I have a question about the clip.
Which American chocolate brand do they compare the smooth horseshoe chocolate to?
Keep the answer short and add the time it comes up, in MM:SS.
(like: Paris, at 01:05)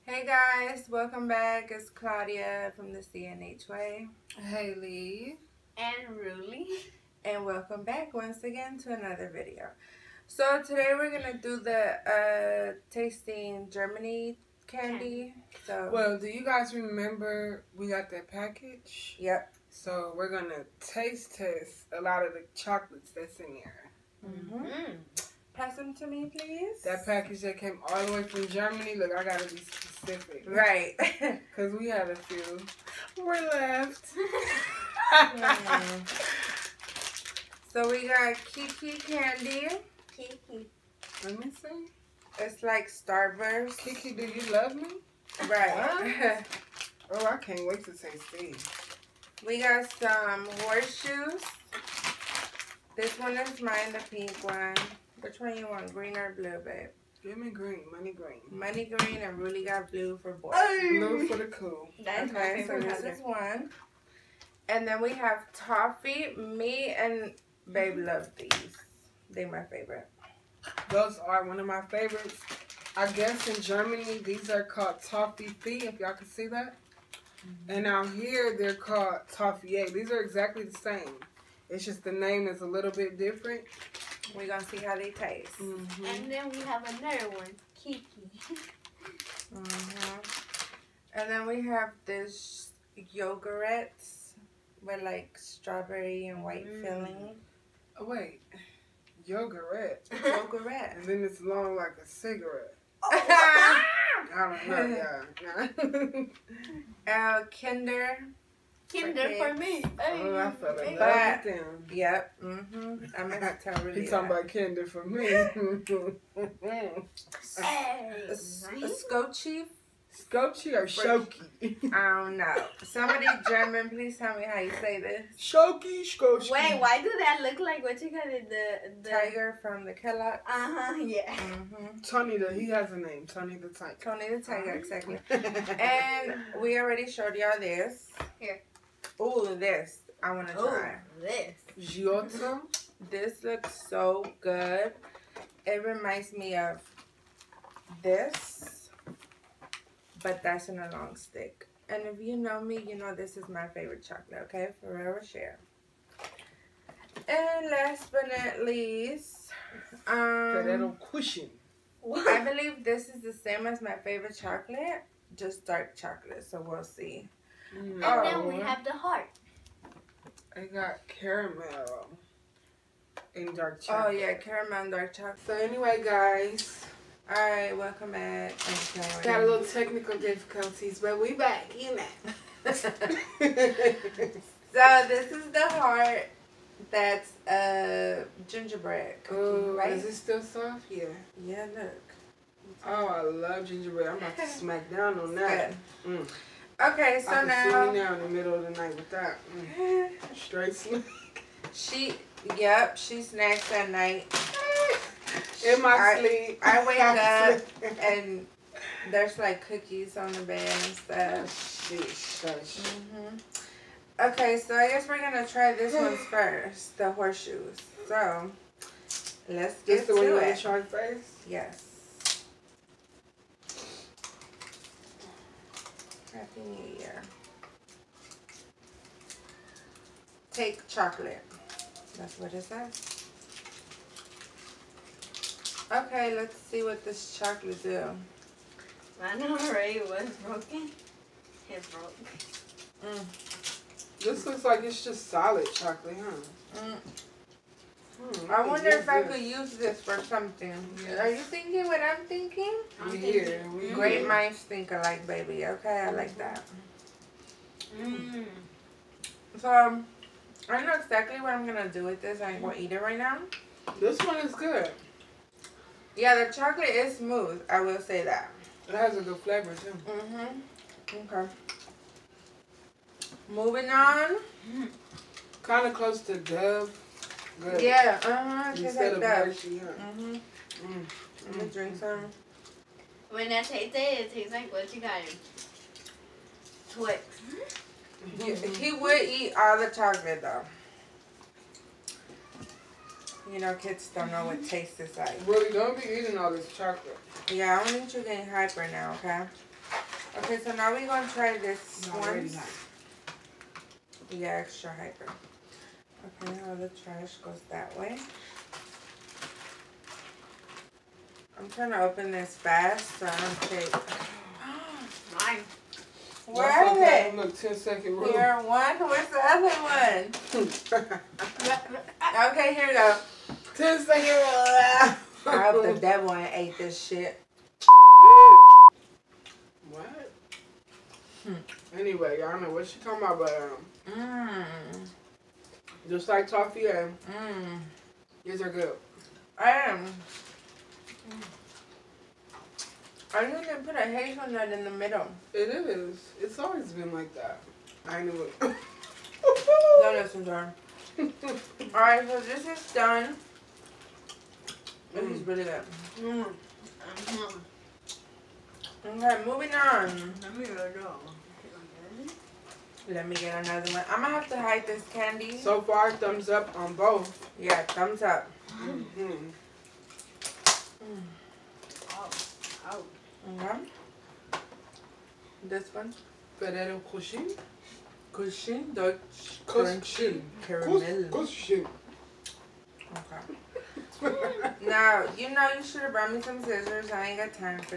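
Dove, at 04:36.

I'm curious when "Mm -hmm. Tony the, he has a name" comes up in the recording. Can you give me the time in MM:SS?
02:11.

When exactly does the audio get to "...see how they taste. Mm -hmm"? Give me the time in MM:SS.
01:24.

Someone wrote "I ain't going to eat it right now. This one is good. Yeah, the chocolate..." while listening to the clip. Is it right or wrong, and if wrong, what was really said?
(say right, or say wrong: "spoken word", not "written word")
right.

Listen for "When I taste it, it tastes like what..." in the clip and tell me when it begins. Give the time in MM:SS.
04:43.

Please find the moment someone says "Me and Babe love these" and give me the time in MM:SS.
01:06.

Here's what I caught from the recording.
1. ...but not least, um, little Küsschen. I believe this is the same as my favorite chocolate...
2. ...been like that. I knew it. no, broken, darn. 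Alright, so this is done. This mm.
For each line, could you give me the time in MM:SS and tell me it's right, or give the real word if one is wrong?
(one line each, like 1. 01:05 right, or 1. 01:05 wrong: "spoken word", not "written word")
1. 02:38 right
2. 05:46 wrong: "listen", not "broken".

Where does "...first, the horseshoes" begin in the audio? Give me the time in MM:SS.
03:36.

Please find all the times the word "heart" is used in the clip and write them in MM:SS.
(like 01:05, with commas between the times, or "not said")
02:48, 03:05.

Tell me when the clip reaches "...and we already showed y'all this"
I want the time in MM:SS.
02:16.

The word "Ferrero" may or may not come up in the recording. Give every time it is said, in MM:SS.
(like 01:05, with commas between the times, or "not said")
02:34, 06:16.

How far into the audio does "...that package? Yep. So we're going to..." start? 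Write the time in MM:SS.
00:18.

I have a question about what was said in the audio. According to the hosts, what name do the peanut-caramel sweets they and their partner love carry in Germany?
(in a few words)
Tofifee.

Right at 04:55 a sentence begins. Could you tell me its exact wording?
Really, don't be eating all this chocolate.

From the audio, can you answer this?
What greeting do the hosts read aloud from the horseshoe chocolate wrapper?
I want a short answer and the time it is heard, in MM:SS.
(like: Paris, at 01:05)
Happy New Year, at 03:46.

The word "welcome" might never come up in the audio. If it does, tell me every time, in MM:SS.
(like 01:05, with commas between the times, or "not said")
00:01, 00:07, 02:57.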